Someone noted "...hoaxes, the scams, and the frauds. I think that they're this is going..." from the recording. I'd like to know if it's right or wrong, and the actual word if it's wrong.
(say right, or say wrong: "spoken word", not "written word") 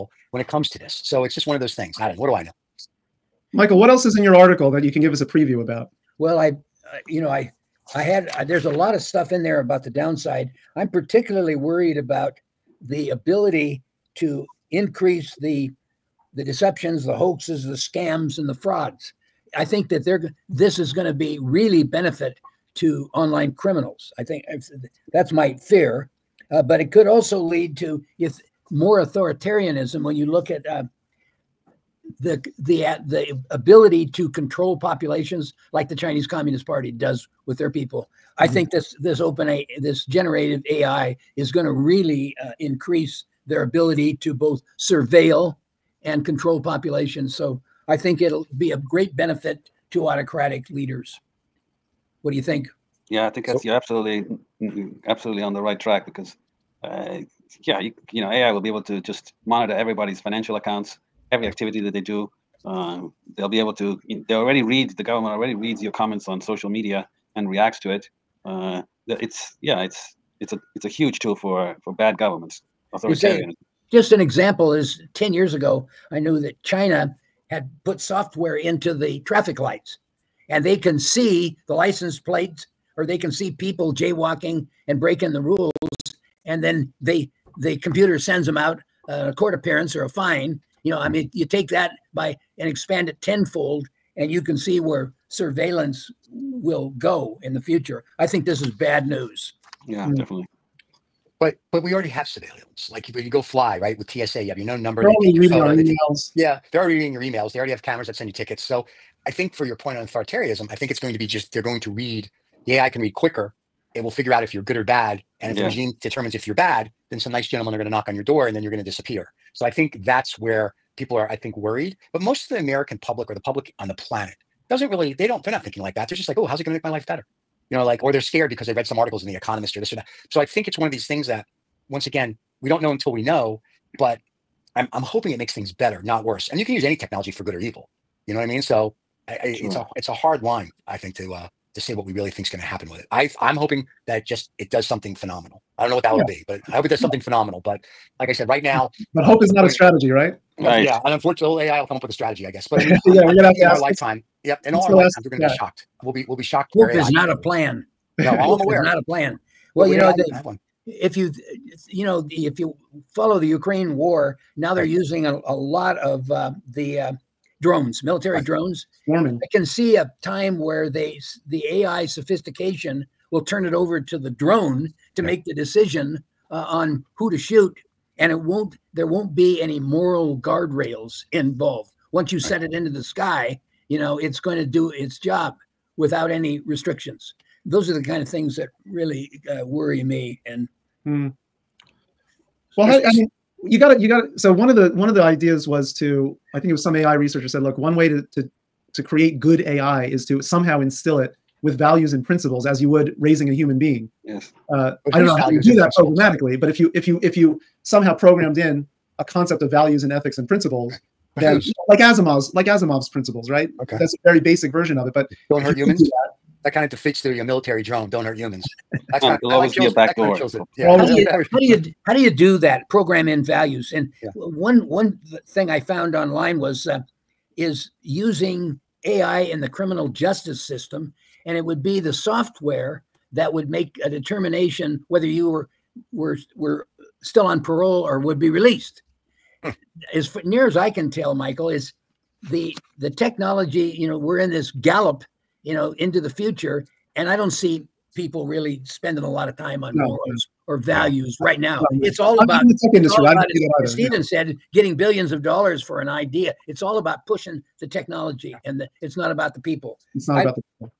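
right.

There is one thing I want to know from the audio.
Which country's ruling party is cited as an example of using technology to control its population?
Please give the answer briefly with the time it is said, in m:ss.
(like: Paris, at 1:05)
Chinese Communist Party, at 0:35.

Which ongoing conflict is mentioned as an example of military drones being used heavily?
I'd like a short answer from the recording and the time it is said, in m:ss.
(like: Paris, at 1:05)
Ukraine war, at 2:43.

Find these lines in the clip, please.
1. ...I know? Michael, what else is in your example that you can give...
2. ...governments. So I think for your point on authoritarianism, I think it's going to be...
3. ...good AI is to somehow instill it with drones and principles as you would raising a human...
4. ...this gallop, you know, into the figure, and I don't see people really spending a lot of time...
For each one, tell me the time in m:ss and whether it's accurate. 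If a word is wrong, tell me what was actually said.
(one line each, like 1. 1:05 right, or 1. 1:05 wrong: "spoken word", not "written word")
1. 0:02 wrong: "article", not "example"
2. 1:48 wrong: "tickets", not "governments"
3. 3:19 wrong: "values", not "drones"
4. 4:04 wrong: "future", not "figure".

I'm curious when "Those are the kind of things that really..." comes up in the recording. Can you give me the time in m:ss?
3:07.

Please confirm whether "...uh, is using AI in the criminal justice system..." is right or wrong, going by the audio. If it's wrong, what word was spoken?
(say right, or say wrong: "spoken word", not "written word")
right.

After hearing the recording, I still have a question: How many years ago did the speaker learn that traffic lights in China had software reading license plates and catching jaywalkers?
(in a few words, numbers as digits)
10.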